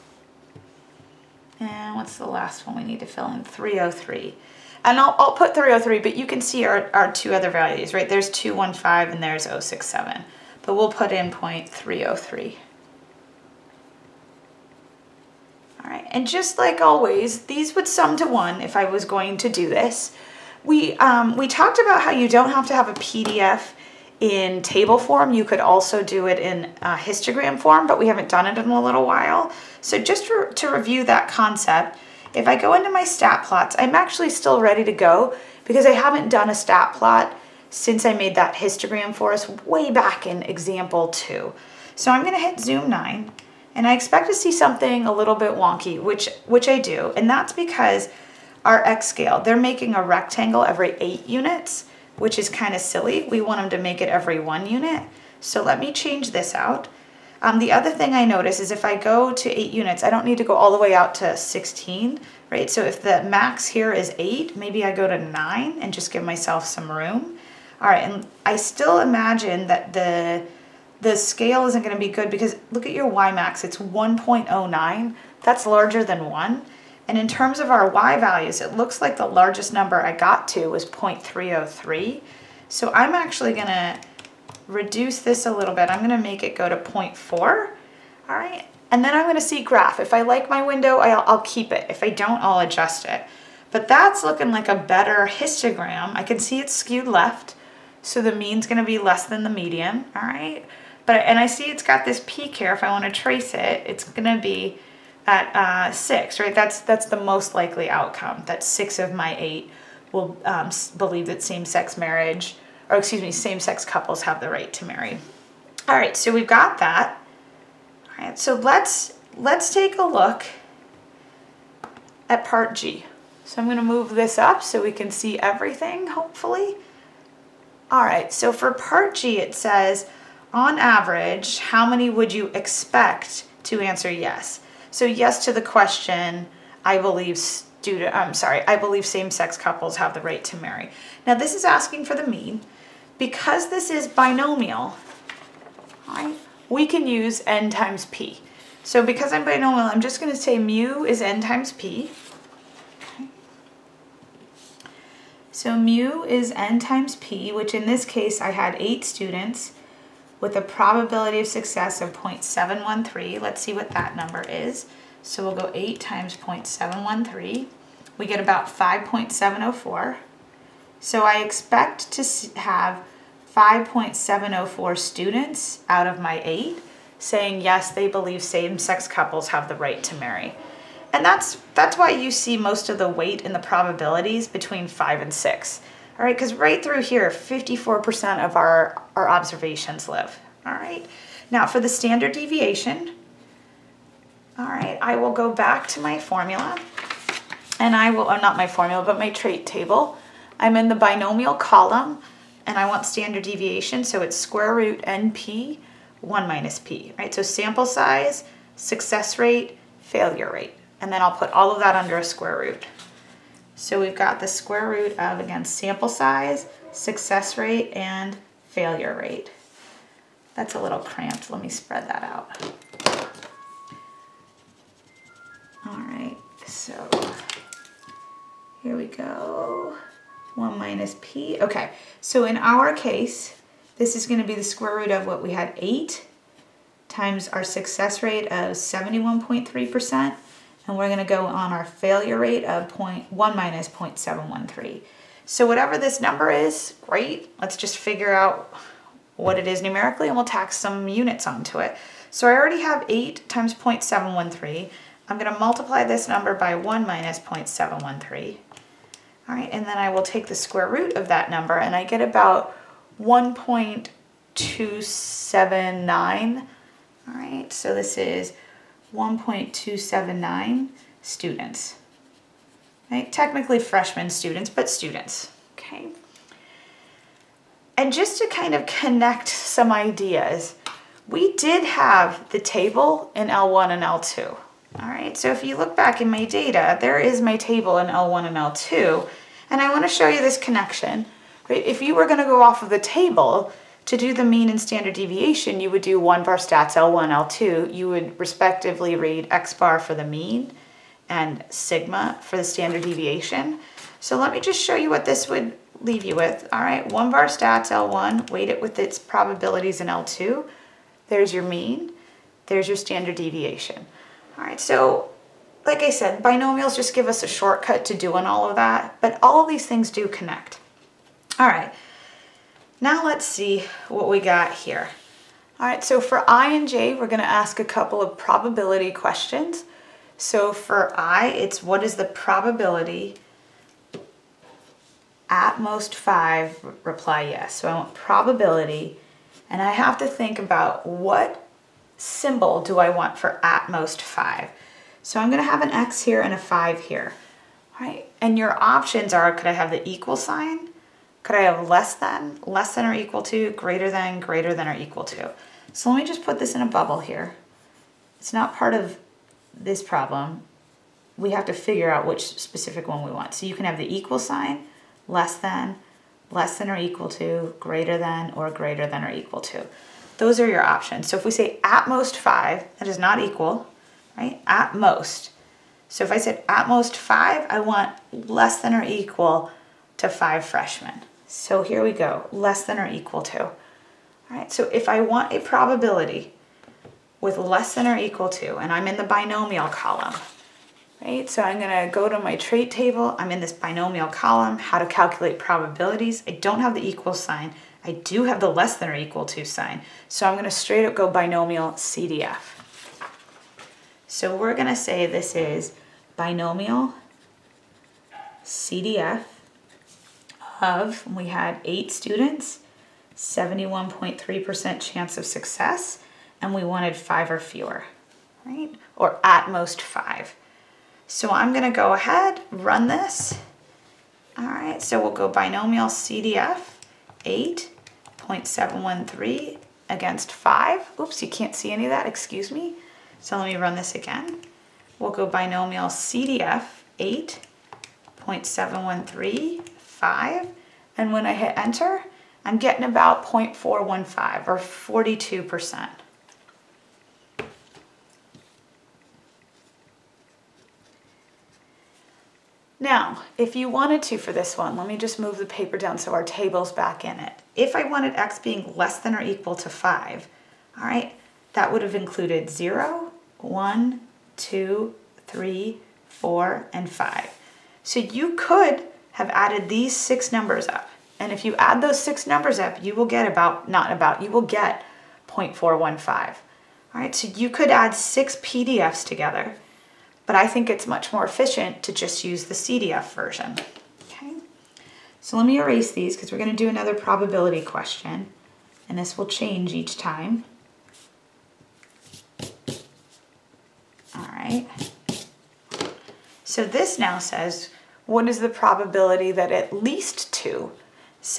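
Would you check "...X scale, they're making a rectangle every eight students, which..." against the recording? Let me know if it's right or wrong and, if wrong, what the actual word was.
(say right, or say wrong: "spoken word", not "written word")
wrong: "units", not "students".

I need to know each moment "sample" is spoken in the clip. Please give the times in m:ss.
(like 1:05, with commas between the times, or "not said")
3:27, 3:35.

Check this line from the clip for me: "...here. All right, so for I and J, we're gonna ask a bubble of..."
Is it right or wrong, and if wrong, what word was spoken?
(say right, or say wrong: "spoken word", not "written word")
wrong: "couple", not "bubble".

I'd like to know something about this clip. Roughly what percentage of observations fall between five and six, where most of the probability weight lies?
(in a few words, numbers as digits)
54%.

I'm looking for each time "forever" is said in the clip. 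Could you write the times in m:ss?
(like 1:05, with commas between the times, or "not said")
not said.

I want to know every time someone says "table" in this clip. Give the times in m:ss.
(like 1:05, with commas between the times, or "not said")
0:24, 3:19, 4:42, 4:47, 4:52, 6:32, 7:36.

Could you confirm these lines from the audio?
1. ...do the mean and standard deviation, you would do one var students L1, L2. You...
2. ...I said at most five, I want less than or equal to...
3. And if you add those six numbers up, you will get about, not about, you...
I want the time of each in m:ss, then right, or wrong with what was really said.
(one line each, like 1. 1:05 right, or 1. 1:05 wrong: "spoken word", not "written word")
1. 4:54 wrong: "stats", not "students"
2. 6:16 right
3. 7:51 right.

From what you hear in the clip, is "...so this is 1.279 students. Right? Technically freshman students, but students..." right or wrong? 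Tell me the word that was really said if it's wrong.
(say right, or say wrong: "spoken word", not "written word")
right.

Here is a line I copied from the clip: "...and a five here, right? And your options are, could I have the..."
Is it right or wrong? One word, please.
right.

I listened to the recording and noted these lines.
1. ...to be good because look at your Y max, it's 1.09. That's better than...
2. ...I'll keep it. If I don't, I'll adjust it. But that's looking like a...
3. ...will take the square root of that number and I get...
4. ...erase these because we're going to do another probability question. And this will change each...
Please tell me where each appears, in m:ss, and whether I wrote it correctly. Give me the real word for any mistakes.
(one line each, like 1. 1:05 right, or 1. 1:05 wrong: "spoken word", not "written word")
1. 1:11 wrong: "larger", not "better"
2. 1:31 right
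3. 4:20 right
4. 8:05 right.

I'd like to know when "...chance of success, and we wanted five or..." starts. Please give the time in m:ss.
6:54.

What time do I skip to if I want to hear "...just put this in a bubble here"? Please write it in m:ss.
5:56.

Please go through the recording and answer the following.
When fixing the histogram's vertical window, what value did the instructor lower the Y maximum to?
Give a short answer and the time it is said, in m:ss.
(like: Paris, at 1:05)
0.4, at 1:26.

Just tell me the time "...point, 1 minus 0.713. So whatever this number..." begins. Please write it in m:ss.
4:02.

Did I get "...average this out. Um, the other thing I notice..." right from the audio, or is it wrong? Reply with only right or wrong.
wrong.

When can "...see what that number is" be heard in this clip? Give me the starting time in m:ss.
2:43.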